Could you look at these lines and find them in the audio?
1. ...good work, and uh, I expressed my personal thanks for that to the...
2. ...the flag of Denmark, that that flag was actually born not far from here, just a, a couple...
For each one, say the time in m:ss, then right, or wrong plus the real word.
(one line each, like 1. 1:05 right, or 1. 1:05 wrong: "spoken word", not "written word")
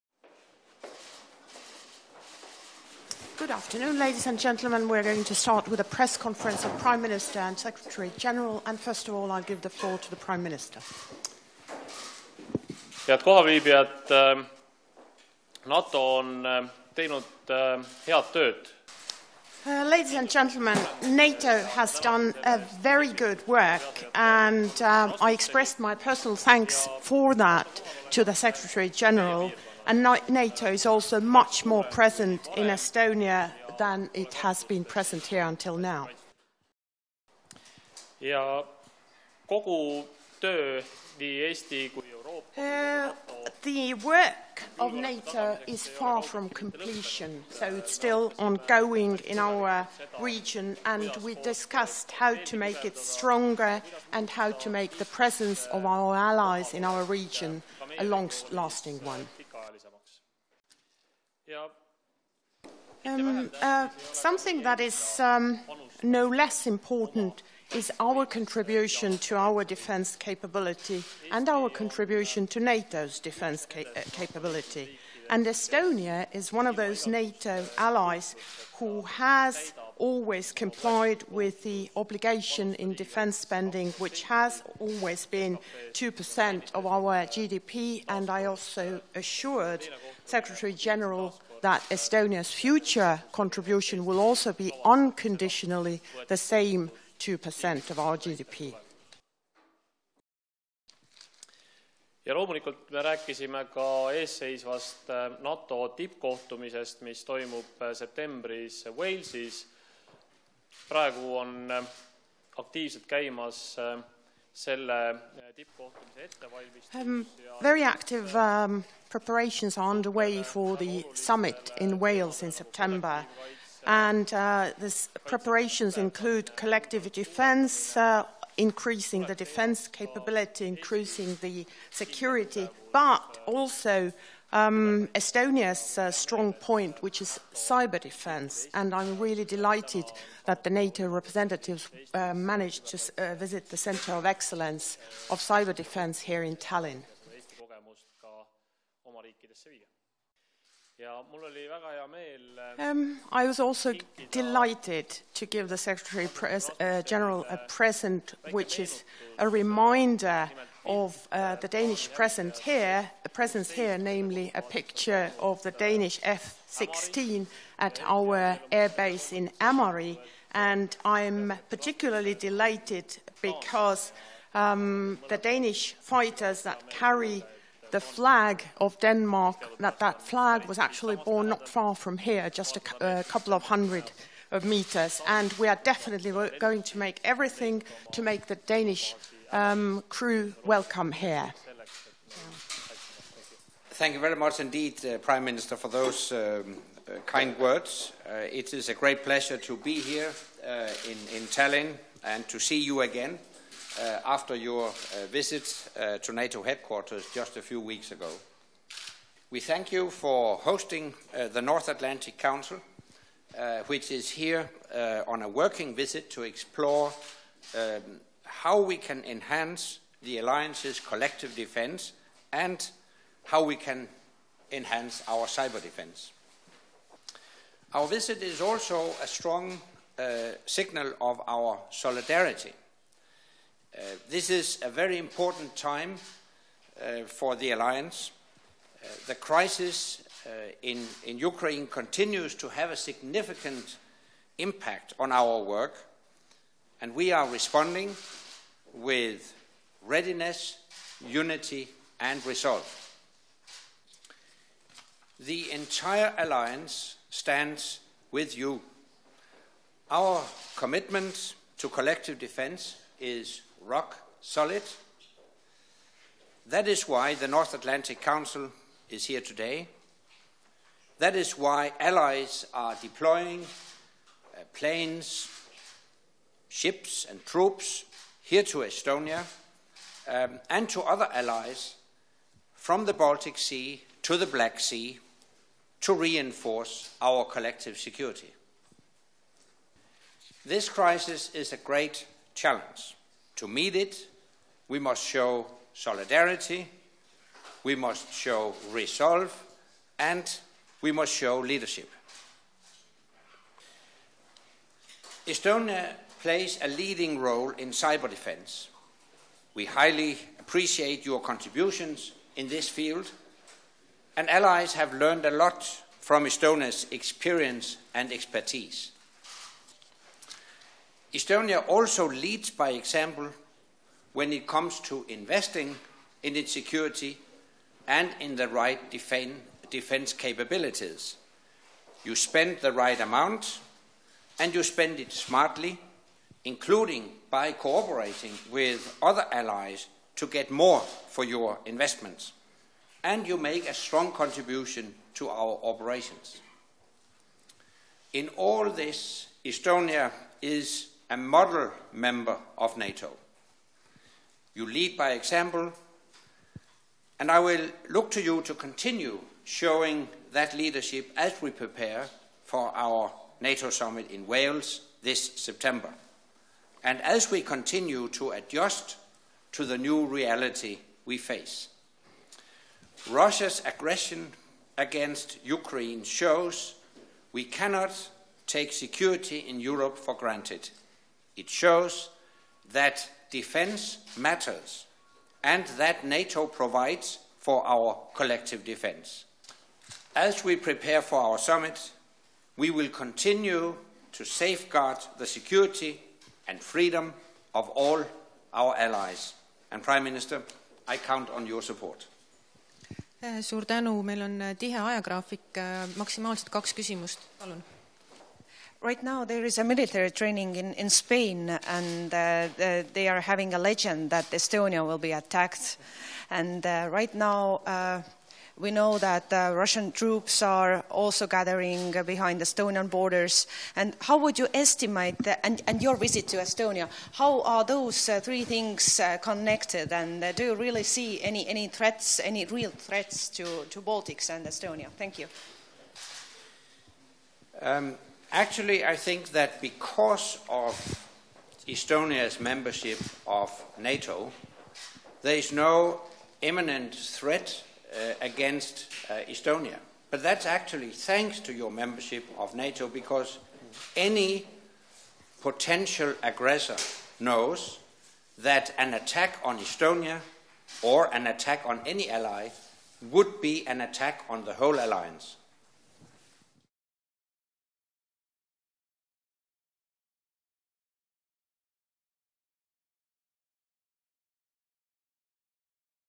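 1. 0:23 right
2. 2:57 right.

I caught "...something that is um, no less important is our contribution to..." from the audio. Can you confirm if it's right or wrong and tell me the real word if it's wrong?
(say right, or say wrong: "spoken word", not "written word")
right.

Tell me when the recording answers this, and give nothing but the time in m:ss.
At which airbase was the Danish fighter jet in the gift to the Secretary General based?
2:49.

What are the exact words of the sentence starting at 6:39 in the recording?
And Prime Minister, I count on your support.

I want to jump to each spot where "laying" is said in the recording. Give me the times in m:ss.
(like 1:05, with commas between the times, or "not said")
not said.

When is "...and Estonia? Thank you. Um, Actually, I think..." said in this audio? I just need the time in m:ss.
7:14.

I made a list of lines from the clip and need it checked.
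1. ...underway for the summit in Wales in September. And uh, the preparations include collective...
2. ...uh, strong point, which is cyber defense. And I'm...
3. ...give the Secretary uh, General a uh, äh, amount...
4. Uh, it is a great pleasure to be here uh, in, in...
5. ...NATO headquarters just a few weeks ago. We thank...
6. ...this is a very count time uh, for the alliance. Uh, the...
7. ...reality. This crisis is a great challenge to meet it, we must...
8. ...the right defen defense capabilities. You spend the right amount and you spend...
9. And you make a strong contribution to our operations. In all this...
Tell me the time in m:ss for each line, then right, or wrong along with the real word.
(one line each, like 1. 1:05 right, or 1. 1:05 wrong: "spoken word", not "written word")
1. 1:59 right
2. 2:15 right
3. 2:35 wrong: "present", not "amount"
4. 3:18 right
5. 3:26 right
6. 3:54 wrong: "important", not "count"
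7. 4:47 wrong: "security", not "reality"
8. 5:28 right
9. 5:43 right.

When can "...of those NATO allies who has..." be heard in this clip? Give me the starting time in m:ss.
1:16.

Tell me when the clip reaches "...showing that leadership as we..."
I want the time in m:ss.
5:59.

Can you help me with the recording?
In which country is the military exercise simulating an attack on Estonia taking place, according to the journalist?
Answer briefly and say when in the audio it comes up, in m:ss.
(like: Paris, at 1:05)
Spain, at 6:51.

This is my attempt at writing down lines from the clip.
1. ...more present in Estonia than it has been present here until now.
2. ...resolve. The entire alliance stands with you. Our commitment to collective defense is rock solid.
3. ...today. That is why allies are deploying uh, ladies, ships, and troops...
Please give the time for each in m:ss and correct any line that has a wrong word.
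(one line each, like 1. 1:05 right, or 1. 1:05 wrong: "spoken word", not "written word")
1. 0:31 right
2. 4:12 right
3. 4:29 wrong: "planes", not "ladies".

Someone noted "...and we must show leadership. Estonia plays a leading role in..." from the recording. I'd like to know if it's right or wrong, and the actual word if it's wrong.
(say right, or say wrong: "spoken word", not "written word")
right.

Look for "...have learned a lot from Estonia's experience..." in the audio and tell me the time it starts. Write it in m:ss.
5:14.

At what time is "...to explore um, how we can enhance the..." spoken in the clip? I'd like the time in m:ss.
3:36.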